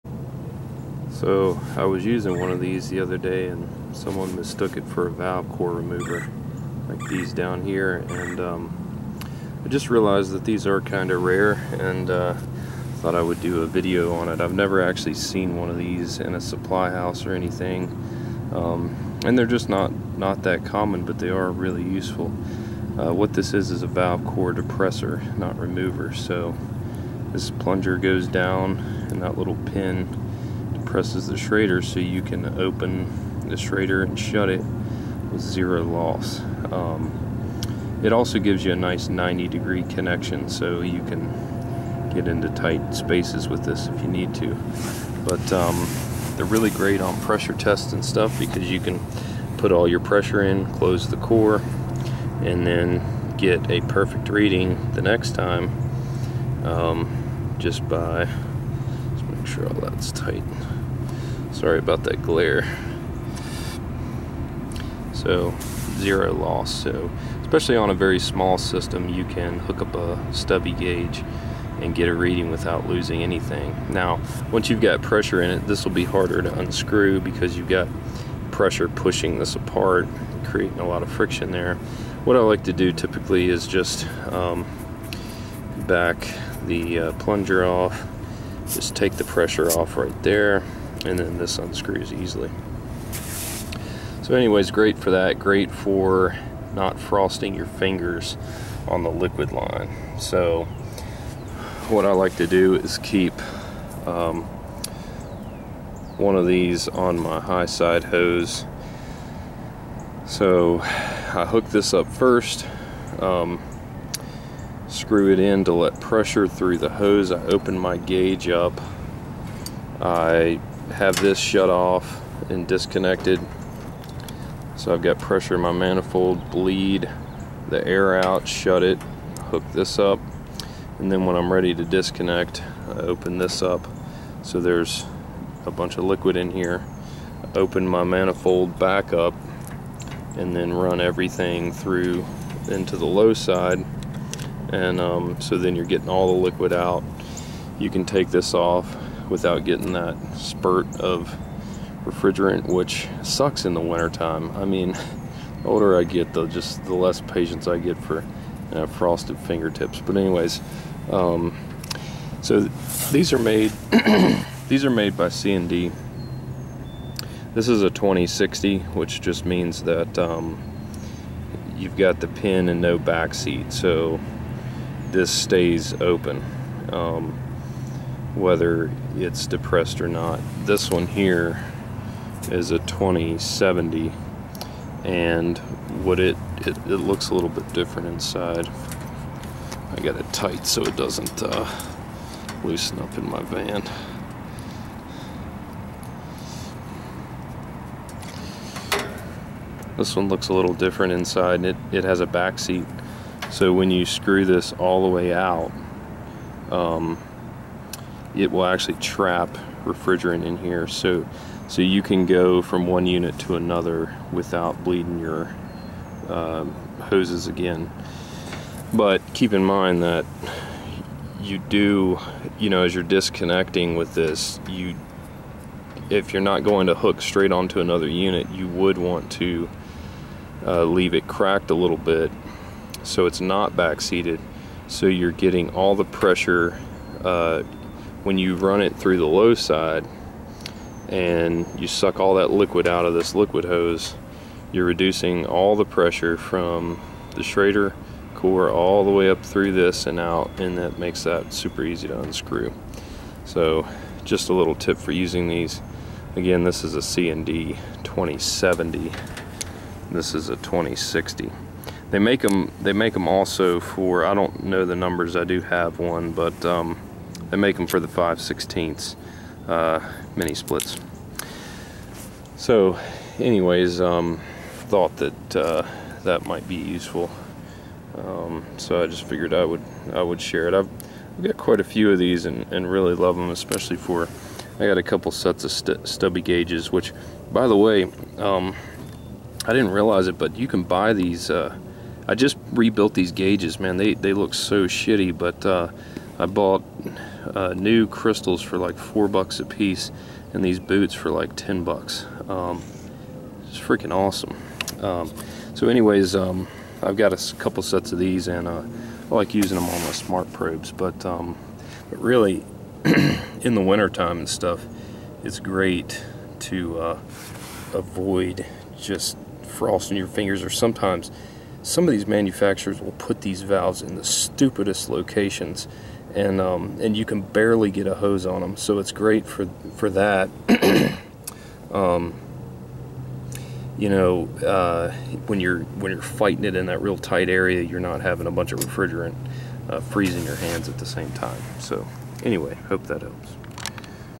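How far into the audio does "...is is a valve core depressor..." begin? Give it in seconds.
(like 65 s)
23 s.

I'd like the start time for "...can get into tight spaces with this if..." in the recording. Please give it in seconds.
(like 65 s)
41 s.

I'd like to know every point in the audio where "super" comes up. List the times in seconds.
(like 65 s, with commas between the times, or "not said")
251 s.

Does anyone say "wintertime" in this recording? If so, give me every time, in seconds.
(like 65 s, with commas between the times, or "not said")
153 s, 313 s.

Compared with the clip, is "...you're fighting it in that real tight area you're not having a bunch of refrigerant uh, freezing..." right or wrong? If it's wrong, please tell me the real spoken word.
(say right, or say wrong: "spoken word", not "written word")
right.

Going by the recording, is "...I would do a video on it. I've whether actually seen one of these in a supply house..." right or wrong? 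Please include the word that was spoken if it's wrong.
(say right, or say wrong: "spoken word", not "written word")
wrong: "never", not "whether".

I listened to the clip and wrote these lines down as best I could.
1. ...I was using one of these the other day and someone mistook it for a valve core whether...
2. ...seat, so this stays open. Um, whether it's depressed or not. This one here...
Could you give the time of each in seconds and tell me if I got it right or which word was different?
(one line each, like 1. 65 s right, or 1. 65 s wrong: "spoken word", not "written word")
1. 1 s wrong: "remover", not "whether"
2. 173 s right.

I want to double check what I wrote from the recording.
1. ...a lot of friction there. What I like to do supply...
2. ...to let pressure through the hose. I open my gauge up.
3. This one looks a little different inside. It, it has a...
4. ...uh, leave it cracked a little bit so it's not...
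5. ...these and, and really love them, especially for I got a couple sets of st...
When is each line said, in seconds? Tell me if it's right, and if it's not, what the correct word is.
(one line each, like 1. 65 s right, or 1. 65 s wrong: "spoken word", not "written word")
1. 80 s wrong: "typically", not "supply"
2. 115 s right
3. 199 s right
4. 230 s right
5. 282 s right.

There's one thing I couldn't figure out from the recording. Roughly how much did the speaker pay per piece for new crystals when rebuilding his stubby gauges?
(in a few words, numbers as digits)
4 dollars.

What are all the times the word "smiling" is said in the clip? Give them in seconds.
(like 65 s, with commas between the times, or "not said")
not said.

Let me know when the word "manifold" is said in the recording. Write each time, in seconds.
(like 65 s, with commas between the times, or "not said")
125 s, 138 s.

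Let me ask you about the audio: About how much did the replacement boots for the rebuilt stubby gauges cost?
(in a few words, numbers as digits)
10 dollars.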